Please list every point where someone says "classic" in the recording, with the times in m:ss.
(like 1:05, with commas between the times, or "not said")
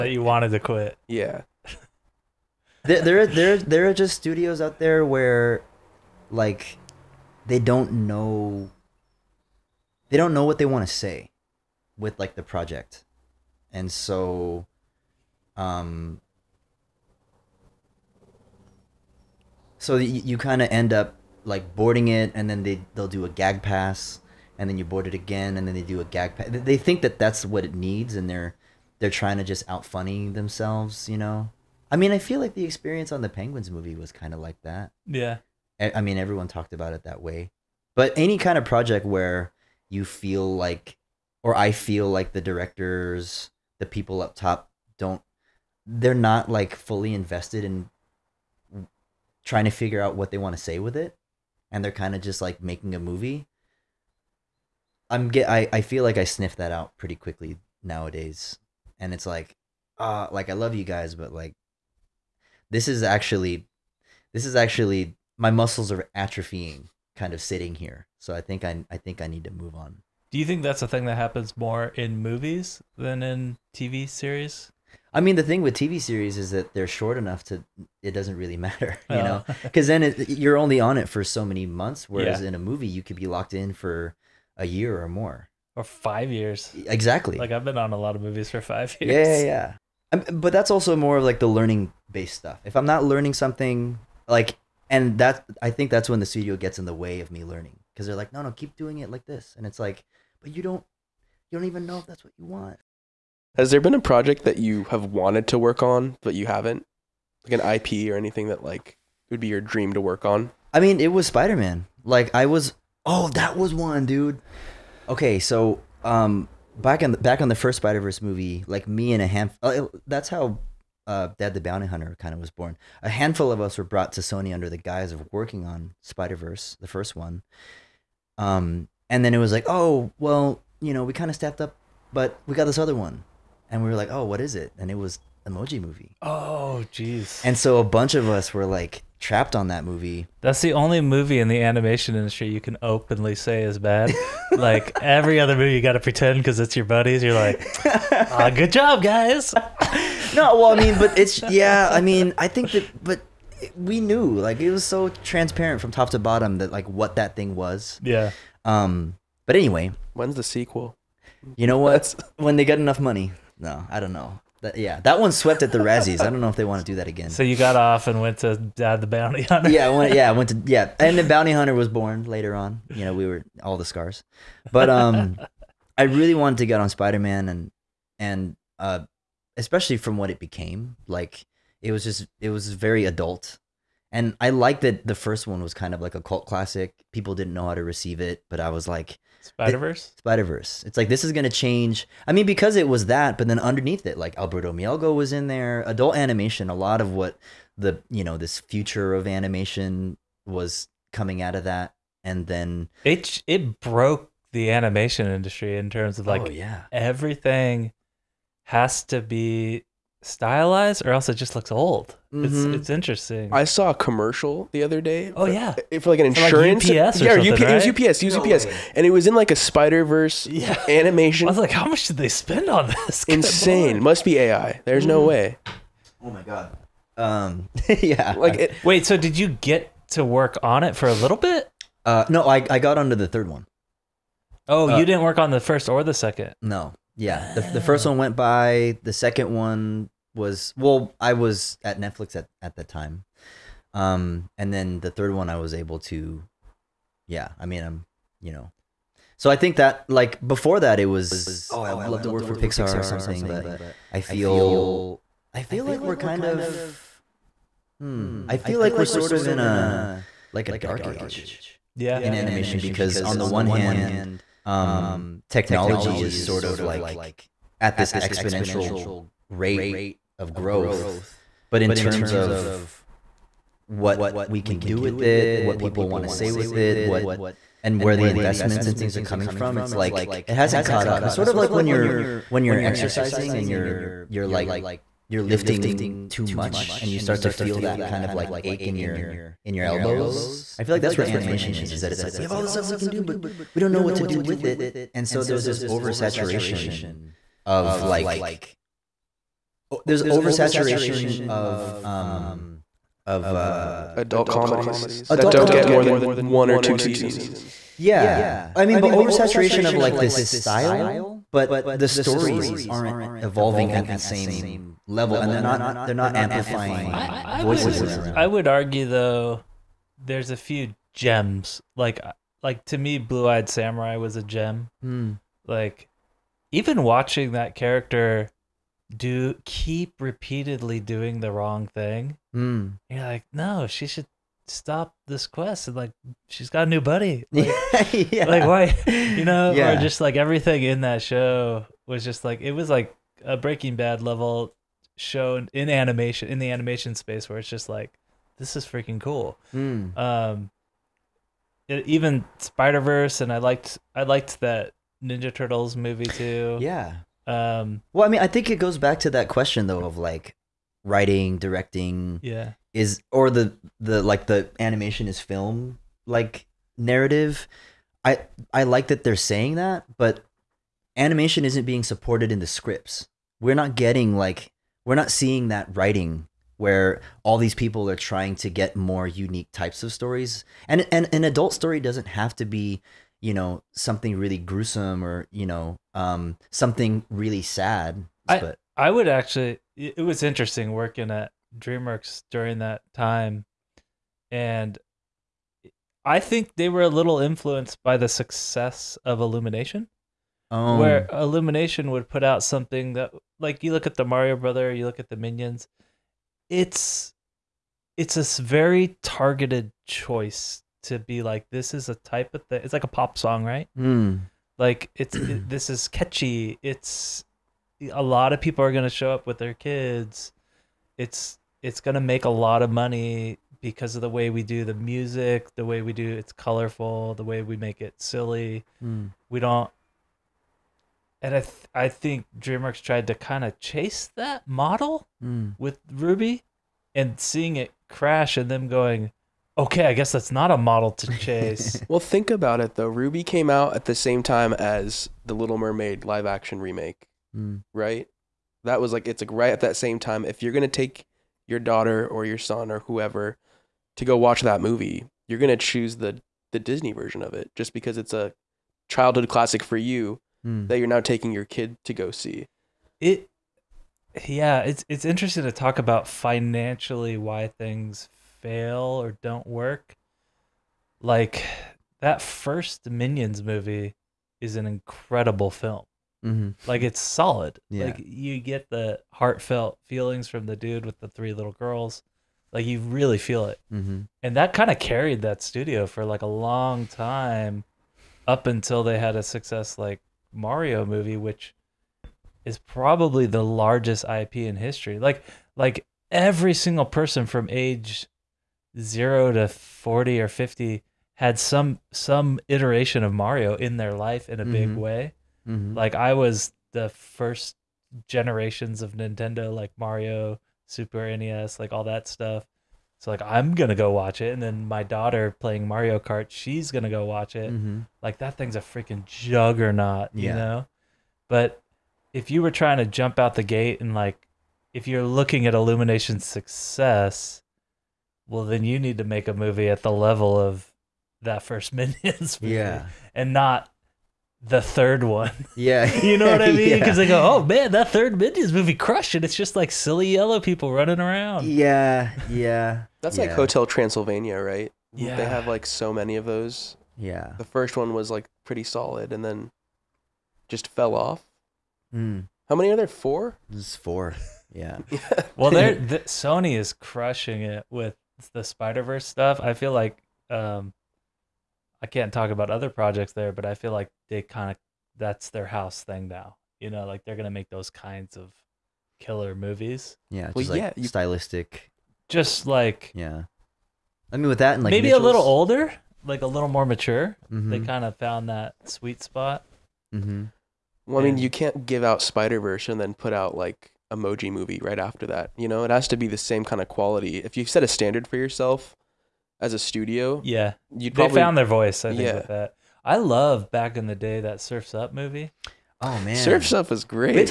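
3:06, 7:39.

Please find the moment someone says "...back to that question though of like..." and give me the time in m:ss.
5:58.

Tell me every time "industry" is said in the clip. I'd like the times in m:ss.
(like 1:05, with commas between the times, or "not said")
2:22, 3:25.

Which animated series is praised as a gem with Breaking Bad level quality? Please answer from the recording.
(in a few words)
Blue-Eyed Samurai.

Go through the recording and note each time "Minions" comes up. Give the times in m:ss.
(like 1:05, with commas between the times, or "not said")
6:45, 7:53, 8:51, 8:58.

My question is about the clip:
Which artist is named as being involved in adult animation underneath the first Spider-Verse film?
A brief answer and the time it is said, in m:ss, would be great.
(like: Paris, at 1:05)
Alberto Mielgo, at 3:14.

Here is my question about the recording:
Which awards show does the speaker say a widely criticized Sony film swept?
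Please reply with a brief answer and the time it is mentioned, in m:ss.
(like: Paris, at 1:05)
The Razzies, at 2:45.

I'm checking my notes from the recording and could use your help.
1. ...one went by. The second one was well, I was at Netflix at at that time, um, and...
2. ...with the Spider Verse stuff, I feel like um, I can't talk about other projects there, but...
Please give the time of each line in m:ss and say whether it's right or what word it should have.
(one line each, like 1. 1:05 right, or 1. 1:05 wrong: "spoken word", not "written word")
1. 3:58 right
2. 9:17 right.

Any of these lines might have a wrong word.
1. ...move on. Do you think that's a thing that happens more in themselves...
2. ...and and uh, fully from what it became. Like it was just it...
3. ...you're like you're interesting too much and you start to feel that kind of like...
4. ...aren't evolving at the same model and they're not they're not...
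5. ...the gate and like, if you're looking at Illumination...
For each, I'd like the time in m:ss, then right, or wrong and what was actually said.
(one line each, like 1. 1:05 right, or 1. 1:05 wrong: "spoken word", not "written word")
1. 1:09 wrong: "movies", not "themselves"
2. 2:57 wrong: "especially", not "fully"
3. 4:44 wrong: "lifting", not "interesting"
4. 5:12 wrong: "level", not "model"
5. 8:43 right.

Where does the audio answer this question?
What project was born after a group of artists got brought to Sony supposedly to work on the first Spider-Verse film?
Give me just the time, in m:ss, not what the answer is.
2:01.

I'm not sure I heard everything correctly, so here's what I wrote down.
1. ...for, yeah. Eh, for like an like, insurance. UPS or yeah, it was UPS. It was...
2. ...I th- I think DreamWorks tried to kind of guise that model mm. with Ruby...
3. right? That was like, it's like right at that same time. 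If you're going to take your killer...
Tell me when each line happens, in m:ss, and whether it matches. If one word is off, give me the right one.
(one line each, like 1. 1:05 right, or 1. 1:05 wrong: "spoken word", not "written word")
1. 3:35 right
2. 7:11 wrong: "chase", not "guise"
3. 7:27 wrong: "daughter", not "killer".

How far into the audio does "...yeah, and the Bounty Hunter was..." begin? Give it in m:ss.
2:50.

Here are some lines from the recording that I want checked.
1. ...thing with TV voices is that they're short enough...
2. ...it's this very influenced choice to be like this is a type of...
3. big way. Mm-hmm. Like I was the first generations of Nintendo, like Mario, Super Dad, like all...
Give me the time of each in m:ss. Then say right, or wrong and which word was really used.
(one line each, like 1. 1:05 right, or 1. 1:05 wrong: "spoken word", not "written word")
1. 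1:15 wrong: "series", not "voices"
2. 6:48 wrong: "targeted", not "influenced"
3. 8:24 wrong: "NES", not "Dad".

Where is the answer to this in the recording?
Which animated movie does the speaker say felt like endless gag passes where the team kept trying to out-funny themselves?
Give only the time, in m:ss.
0:33.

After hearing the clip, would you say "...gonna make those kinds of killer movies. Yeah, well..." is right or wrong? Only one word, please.
right.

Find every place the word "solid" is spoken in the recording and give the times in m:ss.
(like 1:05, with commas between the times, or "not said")
7:57, 9:08.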